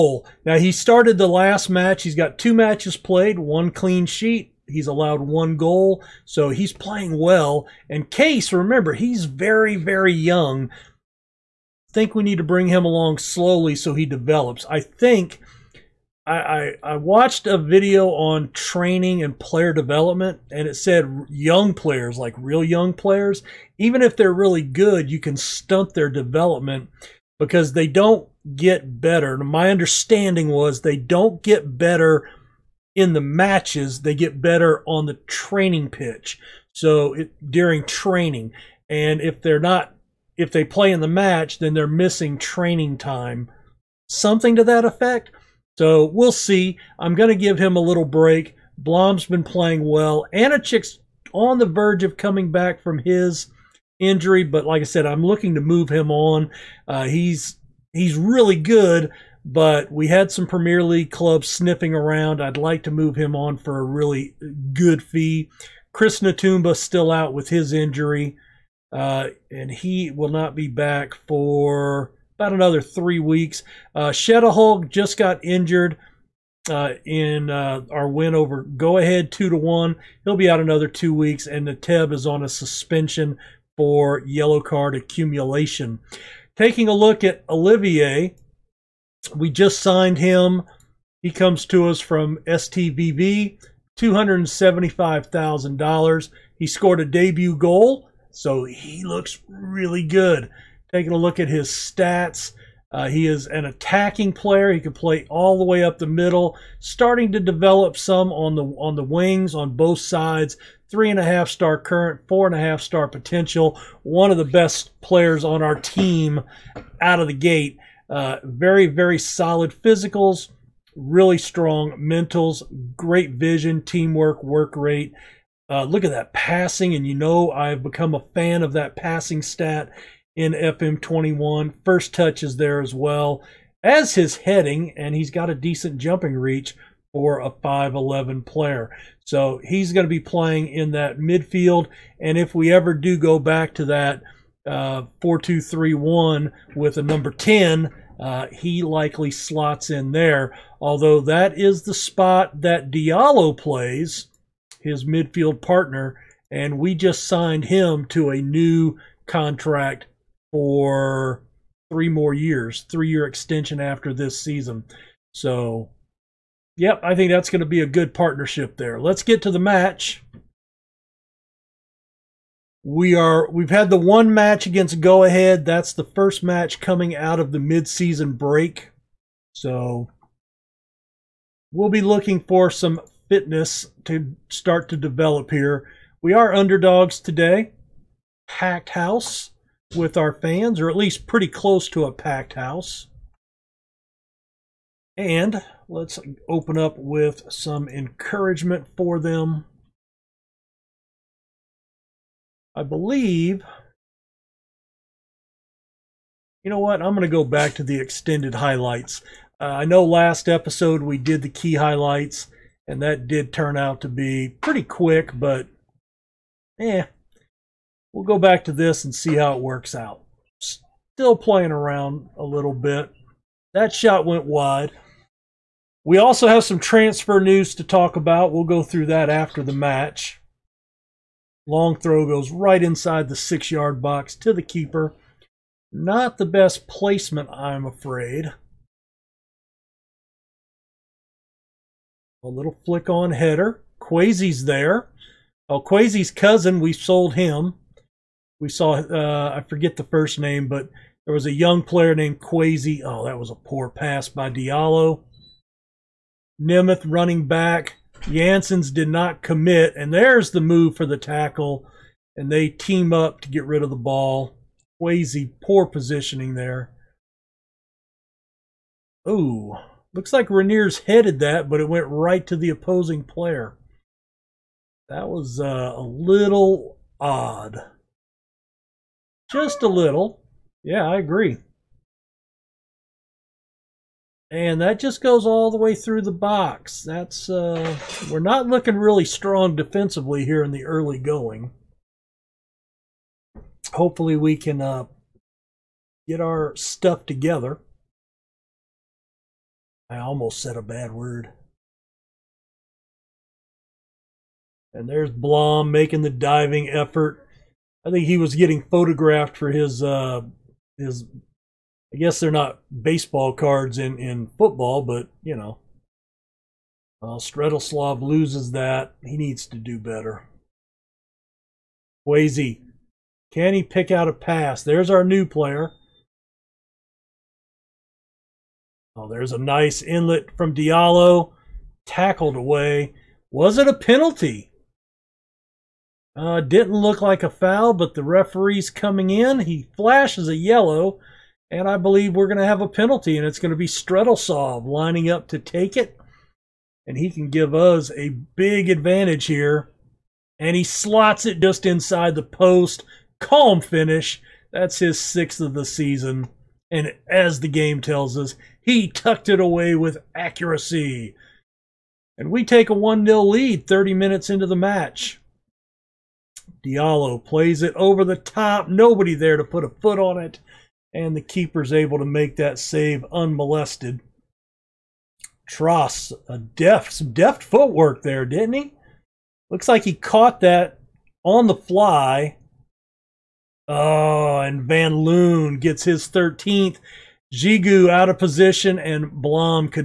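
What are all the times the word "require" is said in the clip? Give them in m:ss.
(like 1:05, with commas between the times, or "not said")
not said.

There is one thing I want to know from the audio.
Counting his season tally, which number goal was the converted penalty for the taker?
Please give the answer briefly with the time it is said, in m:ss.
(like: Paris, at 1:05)
6th, at 5:55.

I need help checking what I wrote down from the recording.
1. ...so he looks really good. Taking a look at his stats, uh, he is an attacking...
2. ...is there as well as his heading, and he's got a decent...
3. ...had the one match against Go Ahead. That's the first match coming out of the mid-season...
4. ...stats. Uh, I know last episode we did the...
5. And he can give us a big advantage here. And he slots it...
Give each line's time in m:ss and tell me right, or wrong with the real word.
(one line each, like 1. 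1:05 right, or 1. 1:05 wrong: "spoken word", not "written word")
1. 1:38 right
2. 2:12 right
3. 2:53 right
4. 3:28 wrong: "highlights", not "stats"
5. 5:47 right.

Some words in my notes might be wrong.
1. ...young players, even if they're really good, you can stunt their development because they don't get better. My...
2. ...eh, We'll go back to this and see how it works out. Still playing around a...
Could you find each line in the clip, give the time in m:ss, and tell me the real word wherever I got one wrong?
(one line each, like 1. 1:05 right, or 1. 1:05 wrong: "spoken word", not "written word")
1. 0:22 right
2. 3:36 right.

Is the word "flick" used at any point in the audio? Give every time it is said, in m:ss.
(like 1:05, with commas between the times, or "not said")
4:02.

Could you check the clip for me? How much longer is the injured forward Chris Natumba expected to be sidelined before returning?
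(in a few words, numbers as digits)
3 weeks.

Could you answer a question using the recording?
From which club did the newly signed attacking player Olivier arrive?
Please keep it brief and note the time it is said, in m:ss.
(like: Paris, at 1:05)
STVV, at 1:32.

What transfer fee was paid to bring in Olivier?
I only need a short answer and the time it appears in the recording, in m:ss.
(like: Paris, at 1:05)
$275,000, at 1:33.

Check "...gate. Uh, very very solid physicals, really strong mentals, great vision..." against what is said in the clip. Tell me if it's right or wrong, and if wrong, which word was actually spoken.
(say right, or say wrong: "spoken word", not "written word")
right.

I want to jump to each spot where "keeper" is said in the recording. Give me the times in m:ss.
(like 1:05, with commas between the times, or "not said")
3:54, 6:11.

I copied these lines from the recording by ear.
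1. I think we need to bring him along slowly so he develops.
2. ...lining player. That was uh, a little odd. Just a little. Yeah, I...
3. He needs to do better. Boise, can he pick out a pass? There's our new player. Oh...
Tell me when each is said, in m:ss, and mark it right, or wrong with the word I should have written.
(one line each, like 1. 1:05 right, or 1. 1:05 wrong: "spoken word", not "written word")
1. 0:10 right
2. 4:32 wrong: "opposing", not "lining"
3. 5:19 right.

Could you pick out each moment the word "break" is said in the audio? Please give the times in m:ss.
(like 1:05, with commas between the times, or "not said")
0:48, 2:58.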